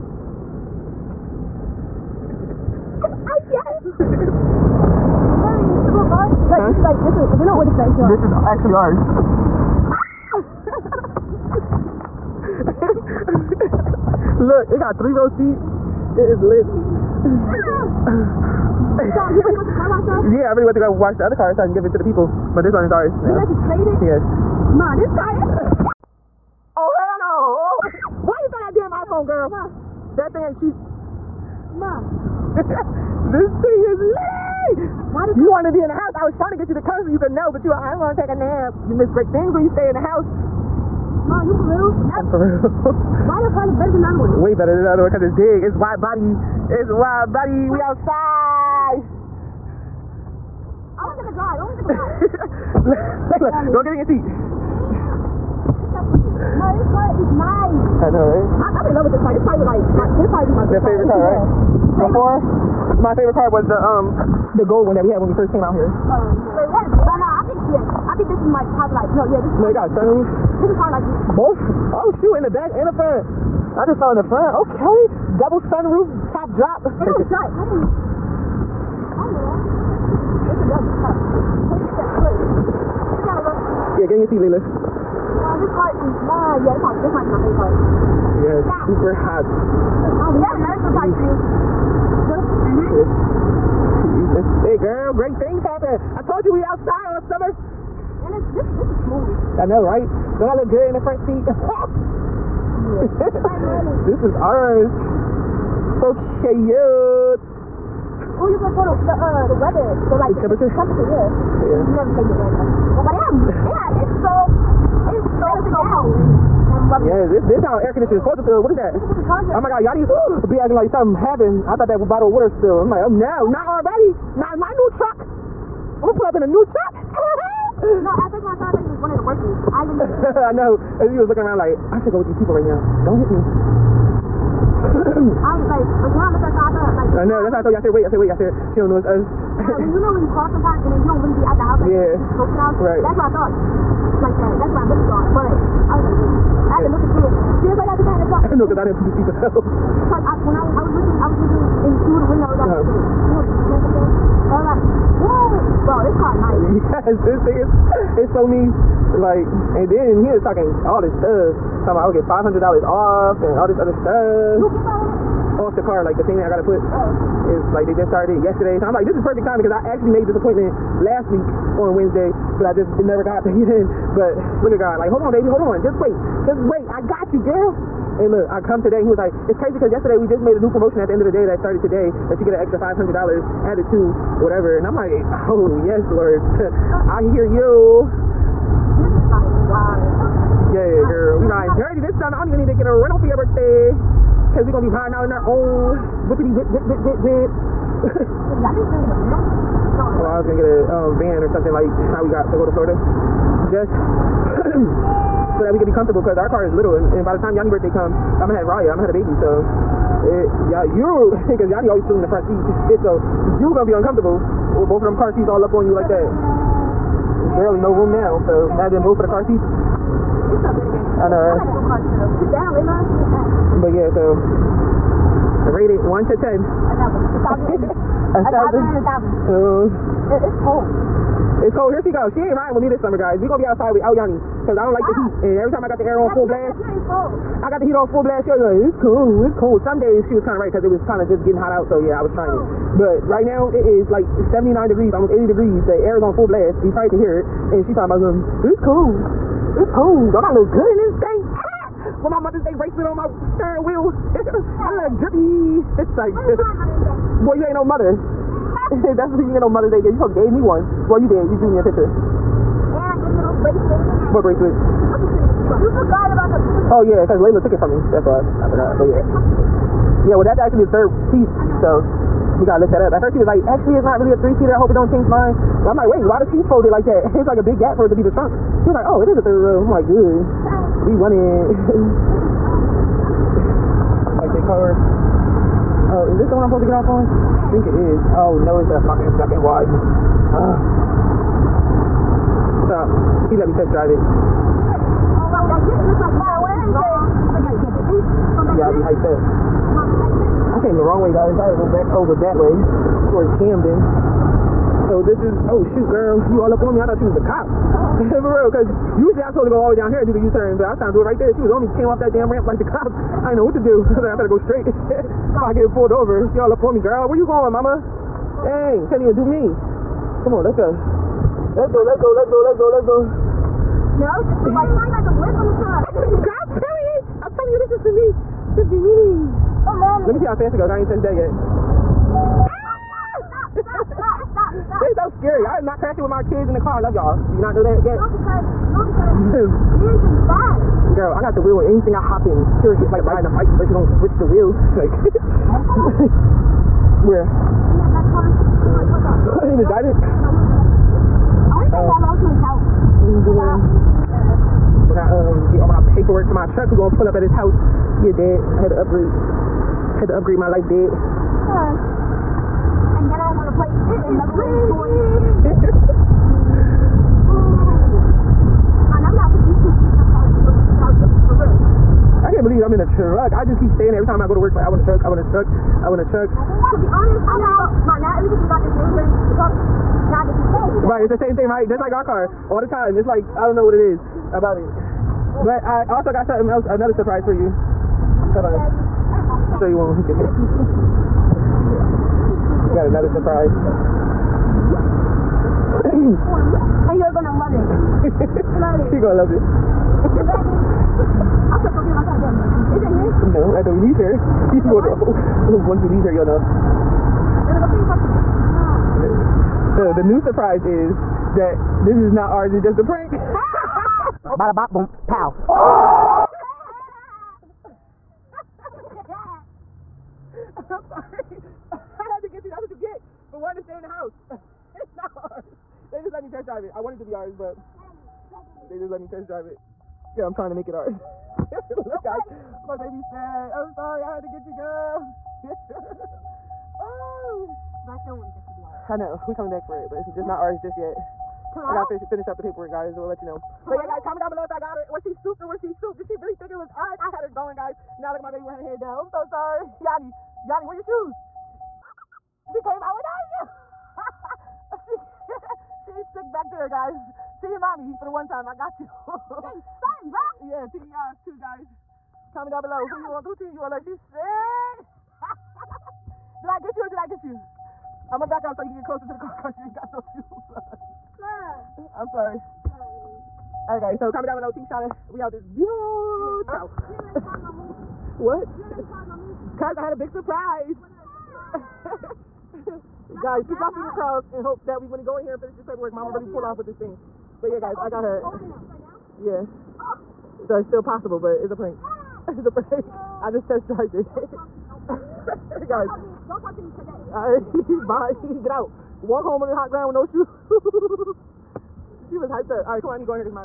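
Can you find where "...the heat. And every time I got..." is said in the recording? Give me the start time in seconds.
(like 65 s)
235 s.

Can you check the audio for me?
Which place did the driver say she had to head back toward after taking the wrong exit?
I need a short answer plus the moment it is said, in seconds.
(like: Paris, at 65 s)
Camden, at 303 s.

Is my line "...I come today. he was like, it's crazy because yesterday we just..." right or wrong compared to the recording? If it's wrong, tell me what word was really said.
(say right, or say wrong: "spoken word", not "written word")
right.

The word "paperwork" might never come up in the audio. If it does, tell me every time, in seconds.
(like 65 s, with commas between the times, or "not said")
356 s, 442 s, 485 s.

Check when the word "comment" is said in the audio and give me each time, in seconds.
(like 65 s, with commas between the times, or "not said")
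444 s, 462 s, 474 s.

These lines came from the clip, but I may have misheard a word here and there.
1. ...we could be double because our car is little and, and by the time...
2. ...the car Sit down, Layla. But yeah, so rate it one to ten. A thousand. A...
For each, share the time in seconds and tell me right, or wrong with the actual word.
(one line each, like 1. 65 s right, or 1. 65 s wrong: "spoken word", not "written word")
1. 205 s wrong: "comfortable", not "double"
2. 221 s right.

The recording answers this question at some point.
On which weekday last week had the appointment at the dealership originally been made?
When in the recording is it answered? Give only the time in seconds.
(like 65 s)
171 s.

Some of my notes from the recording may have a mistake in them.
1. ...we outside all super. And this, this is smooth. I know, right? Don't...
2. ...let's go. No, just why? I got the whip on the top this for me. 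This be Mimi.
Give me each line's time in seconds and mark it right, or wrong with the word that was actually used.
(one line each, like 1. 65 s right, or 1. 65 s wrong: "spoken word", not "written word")
1. 96 s wrong: "summer", not "super"
2. 322 s right.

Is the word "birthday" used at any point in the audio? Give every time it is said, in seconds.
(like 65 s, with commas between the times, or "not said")
193 s, 207 s.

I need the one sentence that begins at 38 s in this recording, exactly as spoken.
You miss great things when you stay in the house.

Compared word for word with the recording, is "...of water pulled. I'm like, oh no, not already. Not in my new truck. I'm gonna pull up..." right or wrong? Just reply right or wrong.
wrong.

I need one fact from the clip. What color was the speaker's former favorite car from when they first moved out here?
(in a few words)
gold.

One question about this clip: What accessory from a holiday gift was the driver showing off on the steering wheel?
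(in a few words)
Mother's Day bracelet.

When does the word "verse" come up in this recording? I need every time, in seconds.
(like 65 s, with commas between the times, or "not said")
not said.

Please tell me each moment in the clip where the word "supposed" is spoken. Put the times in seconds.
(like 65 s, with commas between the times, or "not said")
118 s, 260 s, 286 s, 309 s.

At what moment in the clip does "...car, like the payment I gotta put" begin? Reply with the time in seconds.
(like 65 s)
165 s.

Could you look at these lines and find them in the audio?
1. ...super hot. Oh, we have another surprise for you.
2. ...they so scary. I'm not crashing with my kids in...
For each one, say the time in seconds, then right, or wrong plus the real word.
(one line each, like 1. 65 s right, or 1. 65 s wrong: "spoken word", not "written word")
1. 88 s right
2. 335 s right.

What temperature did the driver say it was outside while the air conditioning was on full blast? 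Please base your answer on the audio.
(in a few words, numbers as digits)
79 degrees.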